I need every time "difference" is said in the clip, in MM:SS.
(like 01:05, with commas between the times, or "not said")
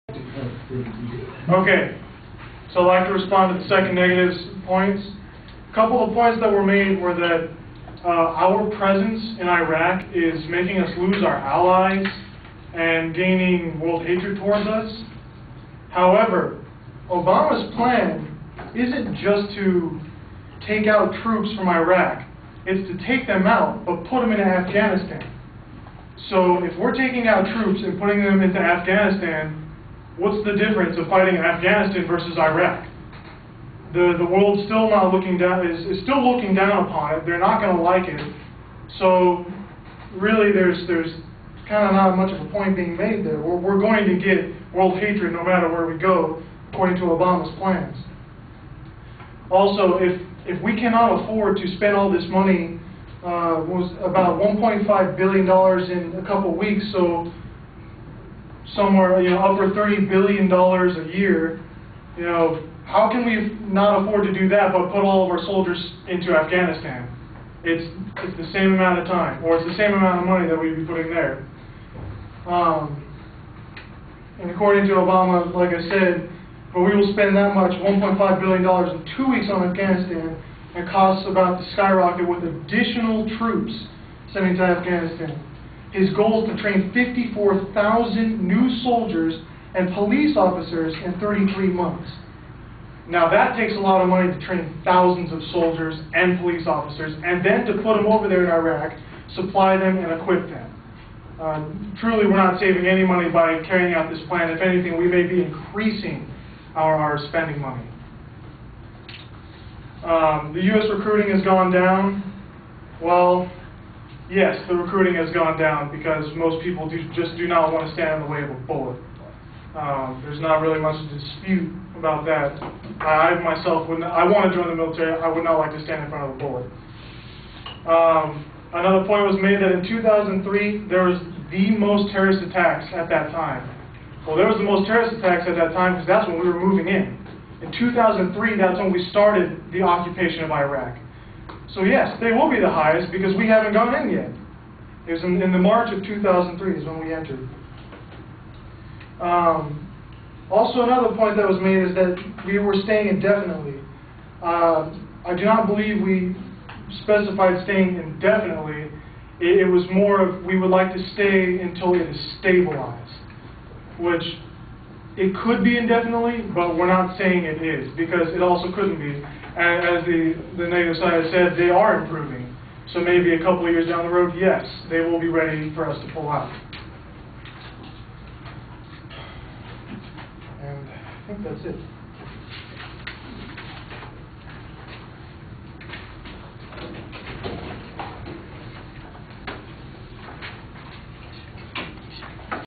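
00:30.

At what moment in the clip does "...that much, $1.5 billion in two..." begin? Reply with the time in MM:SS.
01:17.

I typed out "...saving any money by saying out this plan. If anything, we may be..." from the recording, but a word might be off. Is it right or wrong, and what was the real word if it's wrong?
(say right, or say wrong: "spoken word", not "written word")
wrong: "carrying", not "saying".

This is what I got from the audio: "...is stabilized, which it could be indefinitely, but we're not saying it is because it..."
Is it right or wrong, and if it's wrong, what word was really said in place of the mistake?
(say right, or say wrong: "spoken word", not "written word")
right.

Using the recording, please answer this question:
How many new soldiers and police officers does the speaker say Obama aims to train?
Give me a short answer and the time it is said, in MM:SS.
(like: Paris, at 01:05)
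54,000, at 01:26.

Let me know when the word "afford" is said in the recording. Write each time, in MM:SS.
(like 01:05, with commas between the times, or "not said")
00:51, 01:04.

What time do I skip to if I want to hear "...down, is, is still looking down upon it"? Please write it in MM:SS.
00:35.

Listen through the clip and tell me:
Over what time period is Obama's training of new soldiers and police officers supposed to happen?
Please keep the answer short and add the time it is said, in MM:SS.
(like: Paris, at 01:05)
33 months, at 01:31.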